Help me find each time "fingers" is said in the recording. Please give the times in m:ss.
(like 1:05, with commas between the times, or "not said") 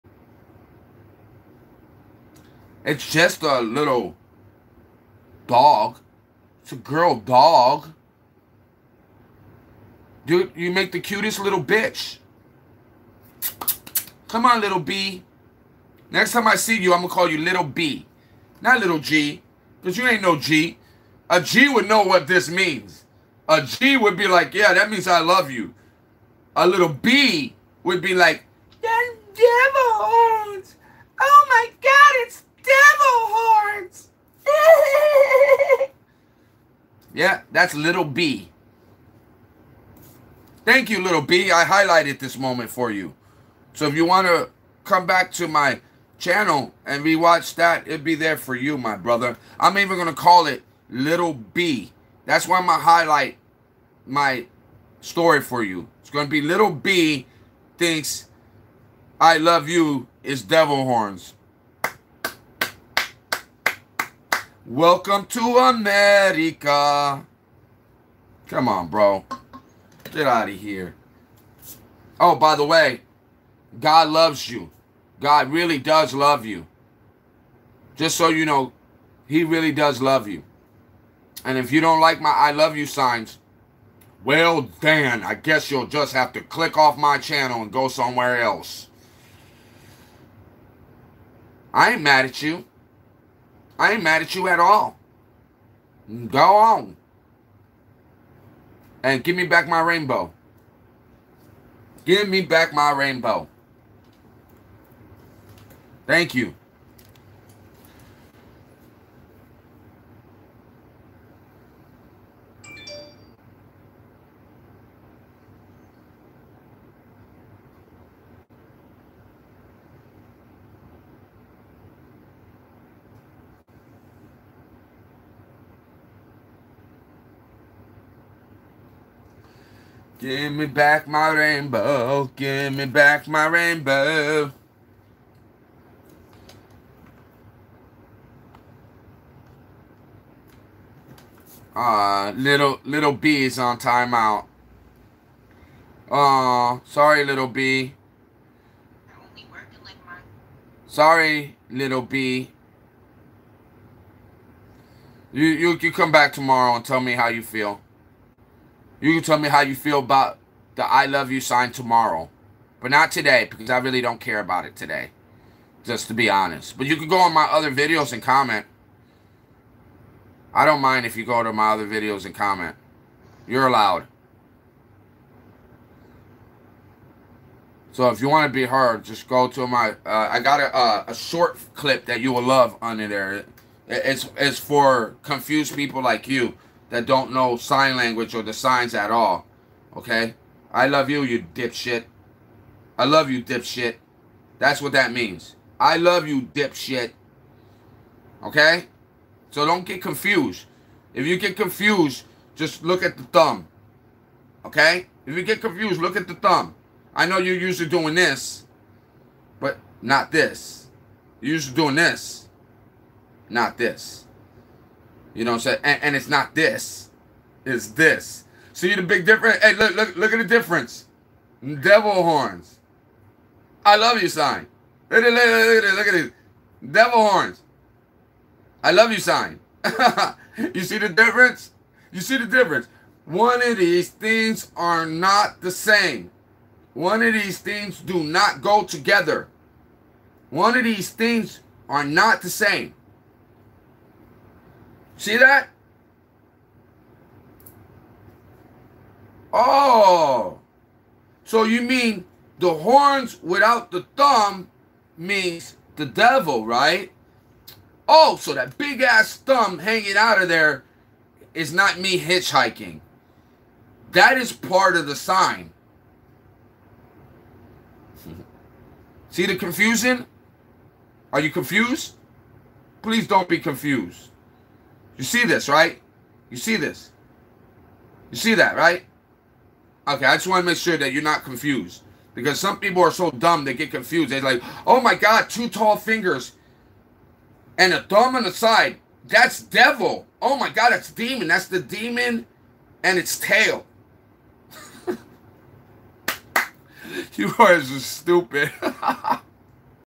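4:45.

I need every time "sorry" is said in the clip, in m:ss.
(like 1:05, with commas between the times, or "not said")
2:26, 2:30.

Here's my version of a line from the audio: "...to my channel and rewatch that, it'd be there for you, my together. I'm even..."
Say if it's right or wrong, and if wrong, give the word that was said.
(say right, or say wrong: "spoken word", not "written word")
wrong: "brother", not "together".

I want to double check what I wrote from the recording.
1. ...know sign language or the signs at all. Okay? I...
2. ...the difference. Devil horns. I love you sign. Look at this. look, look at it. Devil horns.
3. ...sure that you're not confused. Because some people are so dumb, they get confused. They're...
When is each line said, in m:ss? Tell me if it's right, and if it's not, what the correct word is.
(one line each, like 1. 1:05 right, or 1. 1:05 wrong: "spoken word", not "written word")
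1. 3:07 right
2. 3:40 right
3. 4:40 right.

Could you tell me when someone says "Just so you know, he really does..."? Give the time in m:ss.
1:17.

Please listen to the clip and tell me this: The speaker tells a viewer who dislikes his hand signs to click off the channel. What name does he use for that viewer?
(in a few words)
Dan.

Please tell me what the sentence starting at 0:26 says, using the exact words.
A little B would be like, that devil horns.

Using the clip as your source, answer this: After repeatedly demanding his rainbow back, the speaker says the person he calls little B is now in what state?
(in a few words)
timeout.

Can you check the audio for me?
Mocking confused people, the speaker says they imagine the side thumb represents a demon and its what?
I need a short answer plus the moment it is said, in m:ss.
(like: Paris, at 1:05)
tail, at 4:53.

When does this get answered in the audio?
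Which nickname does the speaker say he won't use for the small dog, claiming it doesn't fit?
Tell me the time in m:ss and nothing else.
0:18.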